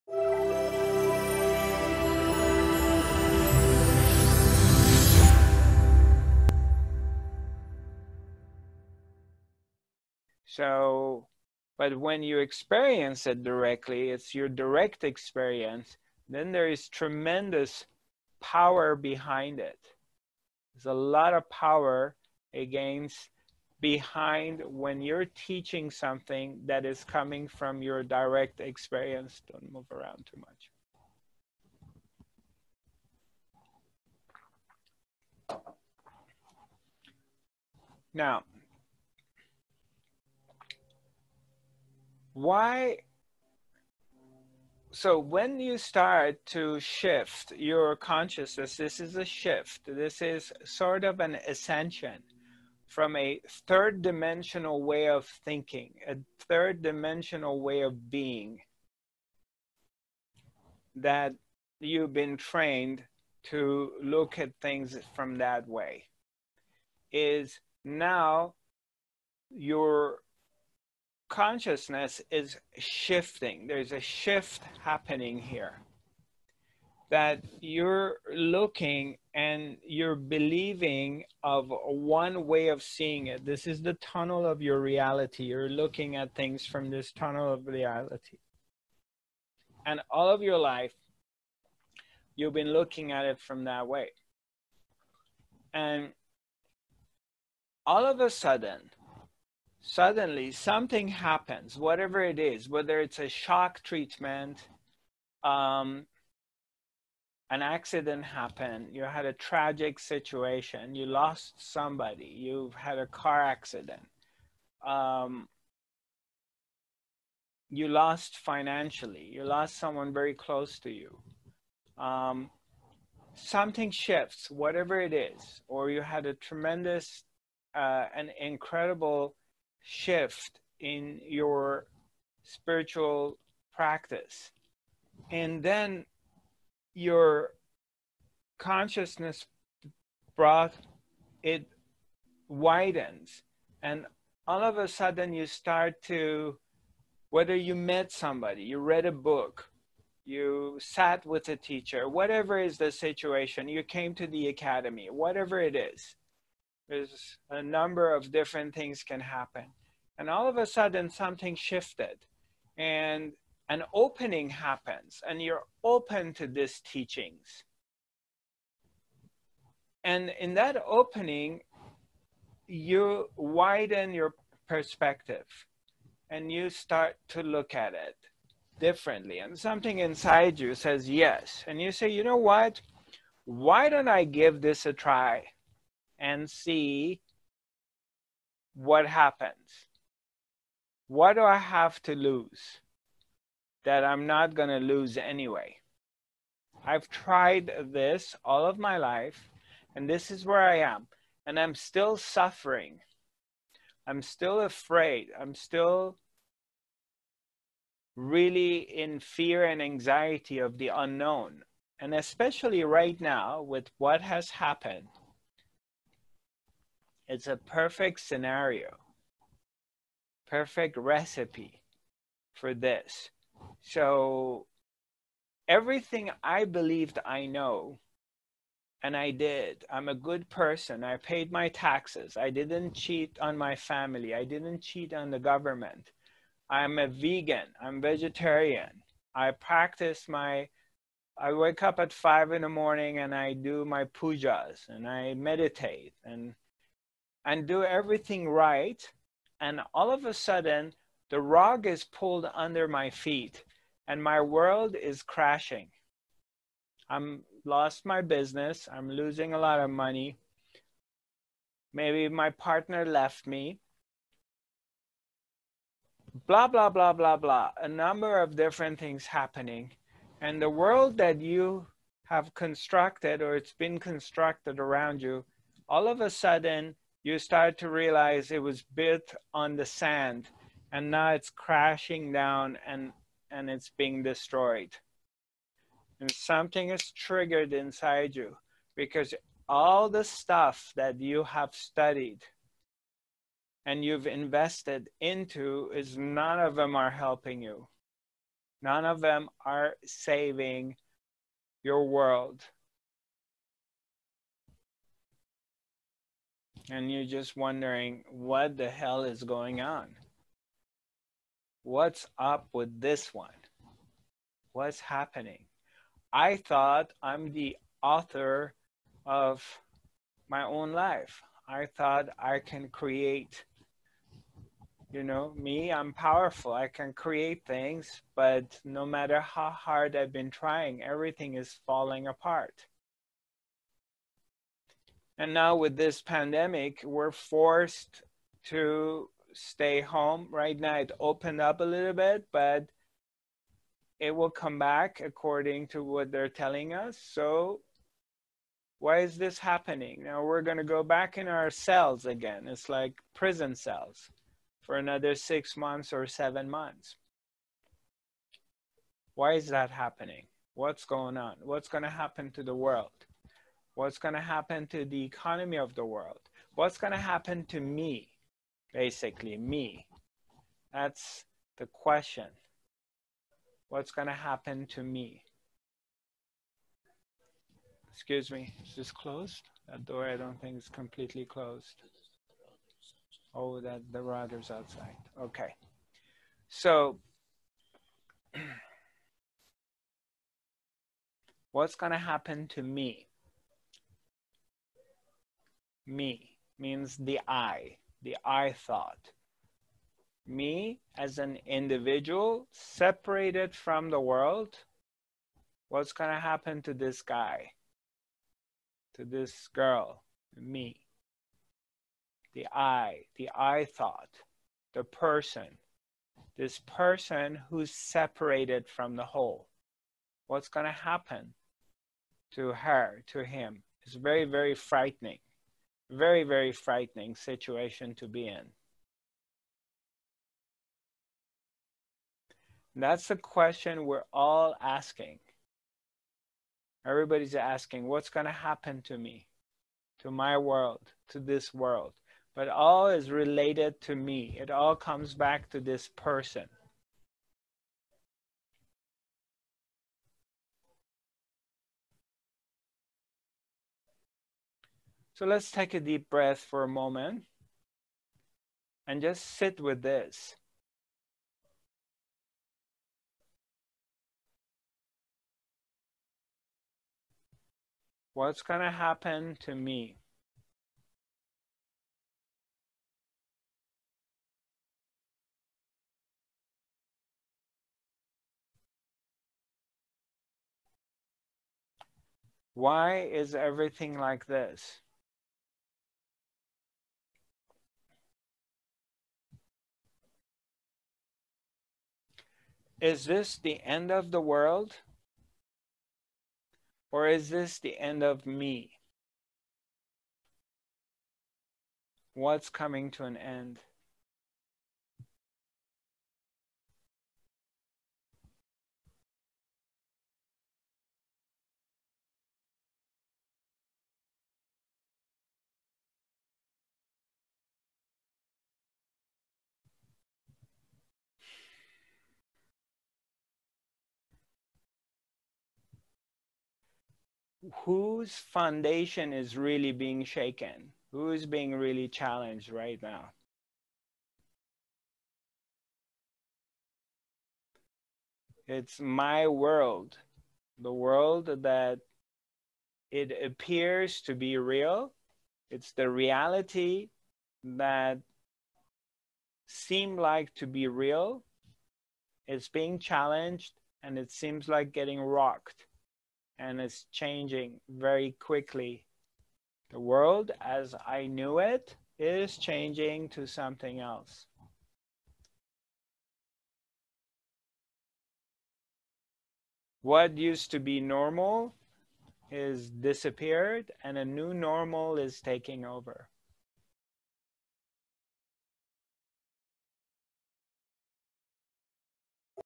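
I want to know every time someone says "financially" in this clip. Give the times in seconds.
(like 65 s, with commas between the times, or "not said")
118 s.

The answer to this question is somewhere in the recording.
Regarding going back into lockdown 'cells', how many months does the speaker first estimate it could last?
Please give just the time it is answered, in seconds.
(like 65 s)
355 s.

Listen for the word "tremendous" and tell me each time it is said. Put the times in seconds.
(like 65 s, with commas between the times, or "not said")
16 s, 126 s.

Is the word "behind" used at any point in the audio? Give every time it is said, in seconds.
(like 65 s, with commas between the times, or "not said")
18 s, 23 s.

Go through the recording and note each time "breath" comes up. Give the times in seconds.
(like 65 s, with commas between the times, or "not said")
456 s.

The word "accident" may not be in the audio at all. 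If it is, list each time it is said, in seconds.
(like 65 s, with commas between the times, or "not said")
107 s, 113 s.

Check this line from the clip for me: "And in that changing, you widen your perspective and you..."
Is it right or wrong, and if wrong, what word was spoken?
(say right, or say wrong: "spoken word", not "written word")
wrong: "opening", not "changing".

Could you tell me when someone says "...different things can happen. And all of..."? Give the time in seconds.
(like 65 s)
158 s.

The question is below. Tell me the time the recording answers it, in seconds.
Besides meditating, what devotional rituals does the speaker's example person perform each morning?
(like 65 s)
244 s.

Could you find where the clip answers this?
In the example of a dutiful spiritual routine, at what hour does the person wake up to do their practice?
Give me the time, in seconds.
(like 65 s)
242 s.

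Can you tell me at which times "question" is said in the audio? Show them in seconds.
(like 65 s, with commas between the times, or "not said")
371 s, 433 s.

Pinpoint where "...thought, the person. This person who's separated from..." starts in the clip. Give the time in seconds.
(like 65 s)
413 s.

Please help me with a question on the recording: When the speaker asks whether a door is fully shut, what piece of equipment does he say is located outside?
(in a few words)
the router.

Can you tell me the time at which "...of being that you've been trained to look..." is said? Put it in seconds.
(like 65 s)
57 s.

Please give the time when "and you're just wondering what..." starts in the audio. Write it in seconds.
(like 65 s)
306 s.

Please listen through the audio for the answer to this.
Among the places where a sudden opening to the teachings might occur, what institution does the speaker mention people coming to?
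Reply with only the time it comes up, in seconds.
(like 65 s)
154 s.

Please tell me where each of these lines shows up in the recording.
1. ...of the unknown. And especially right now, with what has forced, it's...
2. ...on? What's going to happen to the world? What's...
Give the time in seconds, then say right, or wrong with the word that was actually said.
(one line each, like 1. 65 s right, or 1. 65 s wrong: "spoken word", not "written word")
1. 210 s wrong: "happened", not "forced"
2. 361 s right.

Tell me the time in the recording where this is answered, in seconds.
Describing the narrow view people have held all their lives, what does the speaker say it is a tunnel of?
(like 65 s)
83 s.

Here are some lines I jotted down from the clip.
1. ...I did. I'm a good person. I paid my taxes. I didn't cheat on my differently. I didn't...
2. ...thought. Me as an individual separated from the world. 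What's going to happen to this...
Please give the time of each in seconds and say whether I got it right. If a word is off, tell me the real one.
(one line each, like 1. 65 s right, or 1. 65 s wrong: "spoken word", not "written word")
1. 229 s wrong: "family", not "differently"
2. 398 s right.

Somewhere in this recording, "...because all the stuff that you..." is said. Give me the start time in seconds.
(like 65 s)
288 s.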